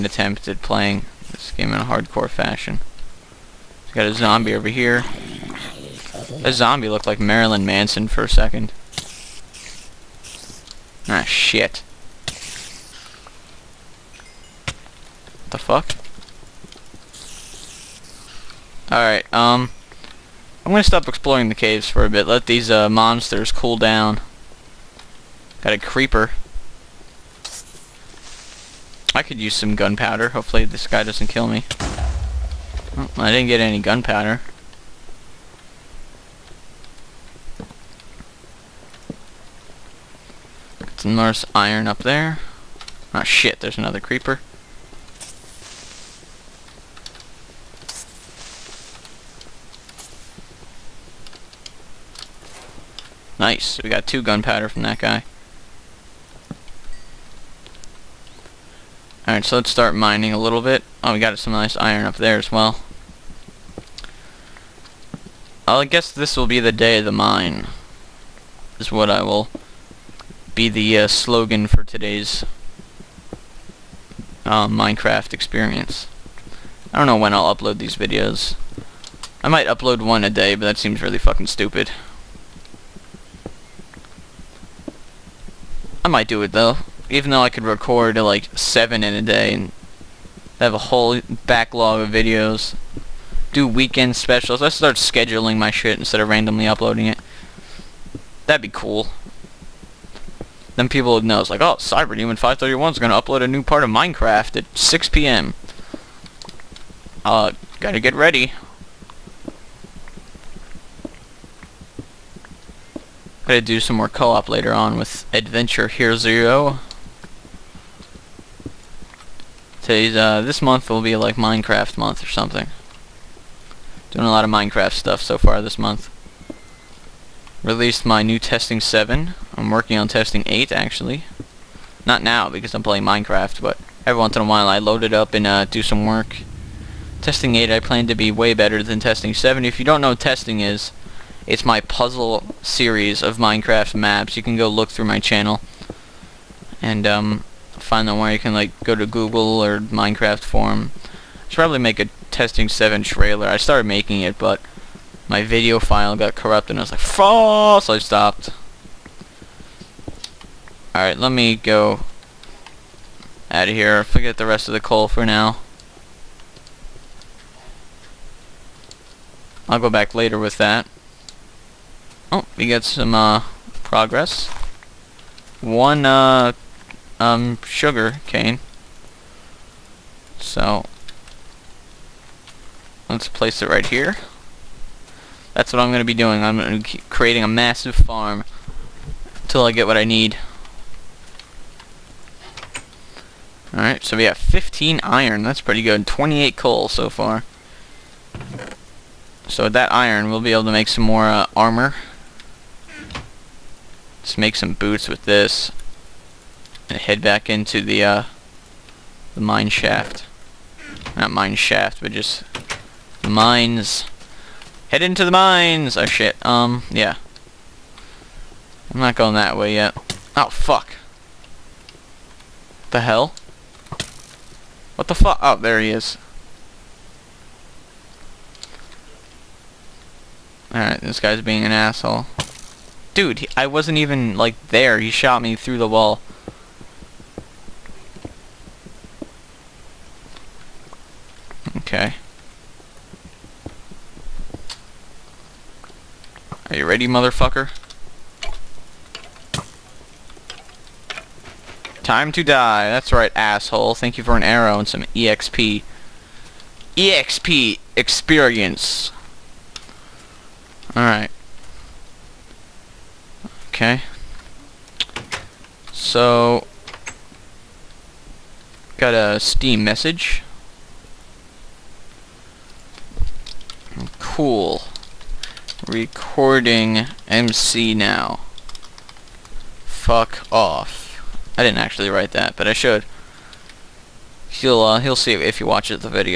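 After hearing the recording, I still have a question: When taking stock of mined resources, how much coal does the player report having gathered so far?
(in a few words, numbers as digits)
28.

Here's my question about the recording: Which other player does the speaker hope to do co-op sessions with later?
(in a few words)
Adventure Hero Zero.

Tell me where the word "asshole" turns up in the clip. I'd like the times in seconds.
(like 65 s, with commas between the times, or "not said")
231 s, 253 s.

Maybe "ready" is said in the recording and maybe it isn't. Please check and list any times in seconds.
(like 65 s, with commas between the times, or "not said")
108 s, 246 s.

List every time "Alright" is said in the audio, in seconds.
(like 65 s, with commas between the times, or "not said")
18 s, 59 s, 160 s, 193 s, 230 s, 260 s.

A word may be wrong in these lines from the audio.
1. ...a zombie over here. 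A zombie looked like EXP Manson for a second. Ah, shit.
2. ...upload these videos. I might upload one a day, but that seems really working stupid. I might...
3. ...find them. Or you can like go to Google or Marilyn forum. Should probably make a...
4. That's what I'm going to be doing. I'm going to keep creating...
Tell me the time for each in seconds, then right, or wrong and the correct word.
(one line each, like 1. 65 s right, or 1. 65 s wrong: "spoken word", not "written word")
1. 4 s wrong: "Marilyn", not "EXP"
2. 77 s wrong: "fucking", not "working"
3. 147 s wrong: "Minecraft", not "Marilyn"
4. 185 s right.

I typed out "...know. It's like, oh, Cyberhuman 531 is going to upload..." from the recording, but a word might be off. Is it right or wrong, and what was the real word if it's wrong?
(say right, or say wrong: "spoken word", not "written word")
right.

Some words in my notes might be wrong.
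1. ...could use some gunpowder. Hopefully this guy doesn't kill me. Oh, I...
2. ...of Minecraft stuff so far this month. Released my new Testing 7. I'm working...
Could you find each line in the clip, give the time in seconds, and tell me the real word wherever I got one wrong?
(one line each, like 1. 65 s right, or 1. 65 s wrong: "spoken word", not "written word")
1. 29 s right
2. 124 s right.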